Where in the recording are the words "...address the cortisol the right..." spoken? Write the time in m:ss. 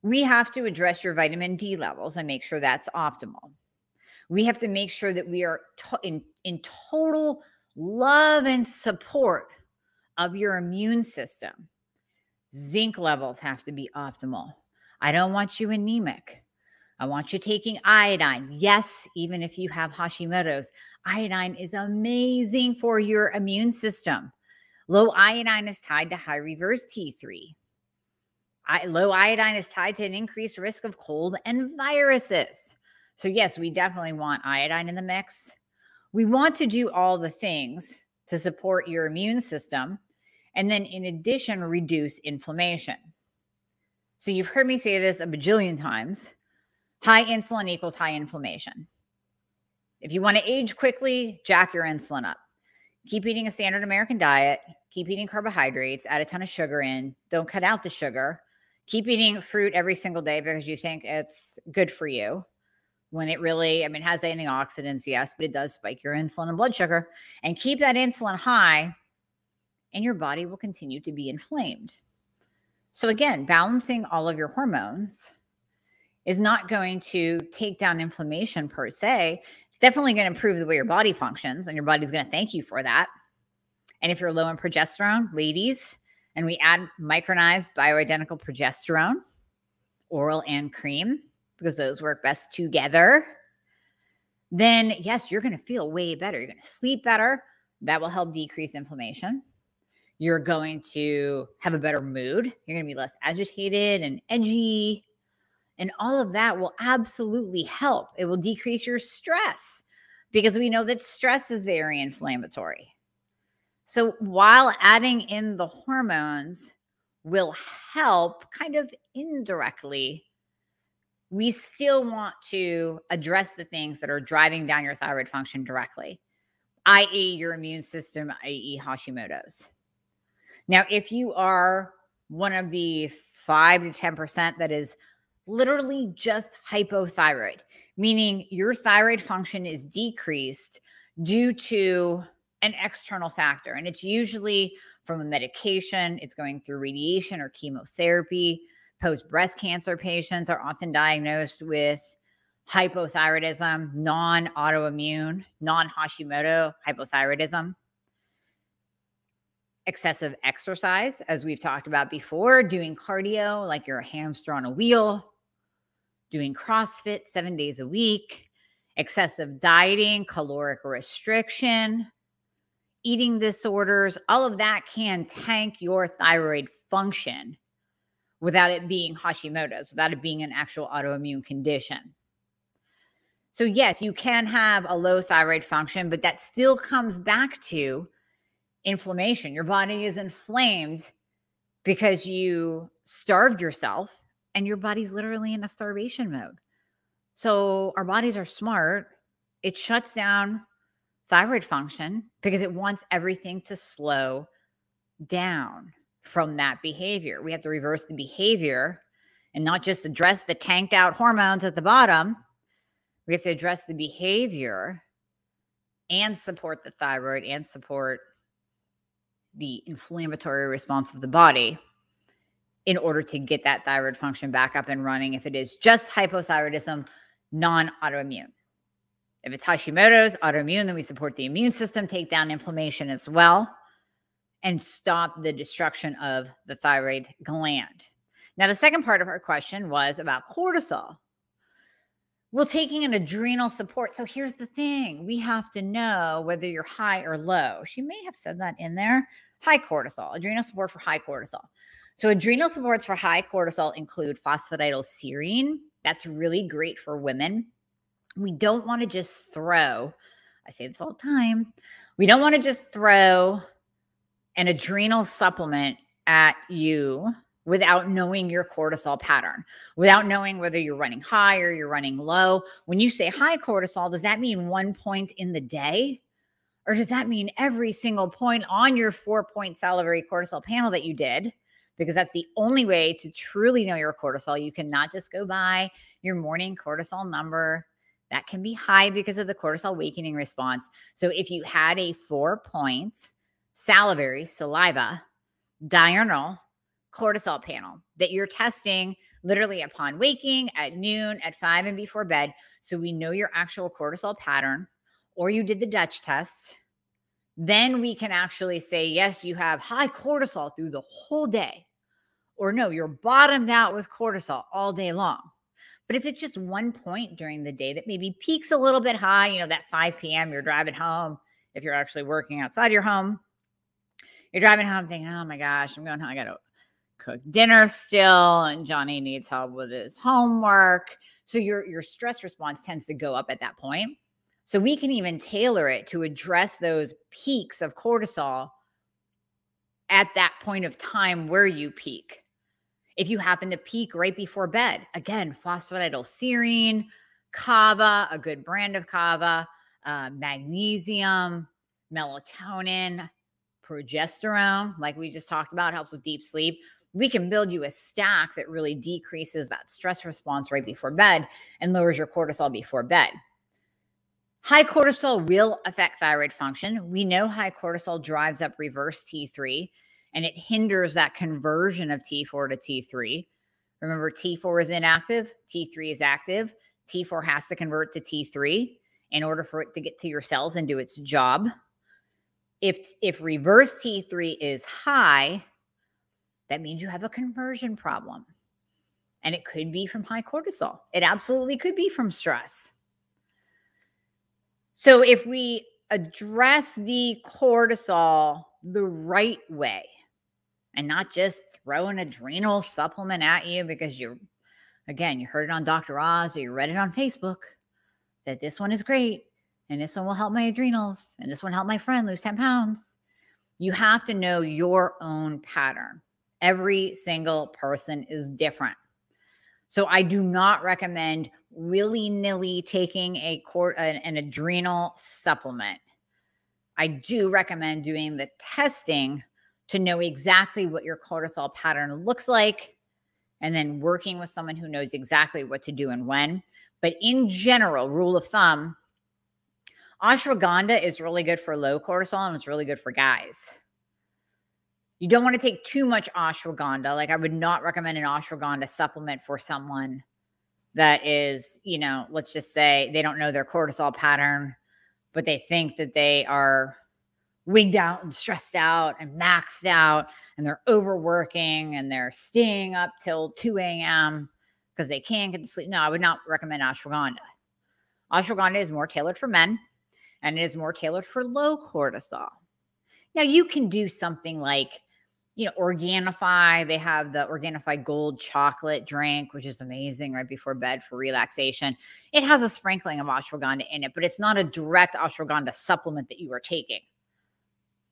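6:36.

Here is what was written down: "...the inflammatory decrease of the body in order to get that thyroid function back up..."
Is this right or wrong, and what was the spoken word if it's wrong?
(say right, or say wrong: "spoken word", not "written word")
wrong: "response", not "decrease".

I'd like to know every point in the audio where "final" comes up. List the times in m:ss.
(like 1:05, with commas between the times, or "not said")
not said.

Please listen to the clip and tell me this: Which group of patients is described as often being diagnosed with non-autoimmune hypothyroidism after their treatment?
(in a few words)
Post breast cancer patients.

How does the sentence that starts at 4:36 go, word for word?
Or does that mean every single point on your four point salivary cortisol panel that you did?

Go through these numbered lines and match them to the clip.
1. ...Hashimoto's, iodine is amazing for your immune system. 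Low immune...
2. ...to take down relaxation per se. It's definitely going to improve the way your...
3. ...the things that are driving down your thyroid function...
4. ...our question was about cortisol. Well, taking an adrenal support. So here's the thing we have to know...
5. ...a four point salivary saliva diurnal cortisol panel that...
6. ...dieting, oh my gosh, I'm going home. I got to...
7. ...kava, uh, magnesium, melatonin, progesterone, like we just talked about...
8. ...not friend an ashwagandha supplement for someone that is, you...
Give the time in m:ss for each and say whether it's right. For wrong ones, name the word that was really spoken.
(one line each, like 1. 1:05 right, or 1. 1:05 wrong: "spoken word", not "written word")
1. 0:19 wrong: "iodine", not "immune"
2. 1:17 wrong: "inflammation", not "relaxation"
3. 2:03 right
4. 3:59 right
5. 4:51 right
6. 5:25 wrong: "thinking", not "dieting"
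7. 5:49 right
8. 7:27 wrong: "recommend", not "friend".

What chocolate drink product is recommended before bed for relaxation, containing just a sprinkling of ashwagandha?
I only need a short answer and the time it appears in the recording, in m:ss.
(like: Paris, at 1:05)
Organifi Gold, at 7:57.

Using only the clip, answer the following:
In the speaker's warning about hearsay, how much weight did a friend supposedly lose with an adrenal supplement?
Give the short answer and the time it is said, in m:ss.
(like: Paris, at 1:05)
10 pounds, at 6:52.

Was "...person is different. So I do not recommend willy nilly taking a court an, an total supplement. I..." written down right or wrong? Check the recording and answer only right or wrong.
wrong.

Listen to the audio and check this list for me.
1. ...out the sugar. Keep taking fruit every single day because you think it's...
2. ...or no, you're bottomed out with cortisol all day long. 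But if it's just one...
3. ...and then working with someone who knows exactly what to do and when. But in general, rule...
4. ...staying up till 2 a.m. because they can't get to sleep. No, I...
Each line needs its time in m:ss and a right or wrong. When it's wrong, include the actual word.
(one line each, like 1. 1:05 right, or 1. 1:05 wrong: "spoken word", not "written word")
1. 0:57 wrong: "eating", not "taking"
2. 5:12 right
3. 7:13 right
4. 7:42 right.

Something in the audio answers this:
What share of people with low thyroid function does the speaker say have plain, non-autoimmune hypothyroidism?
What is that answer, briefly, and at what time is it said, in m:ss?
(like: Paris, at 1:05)
5 to 10%, at 2:13.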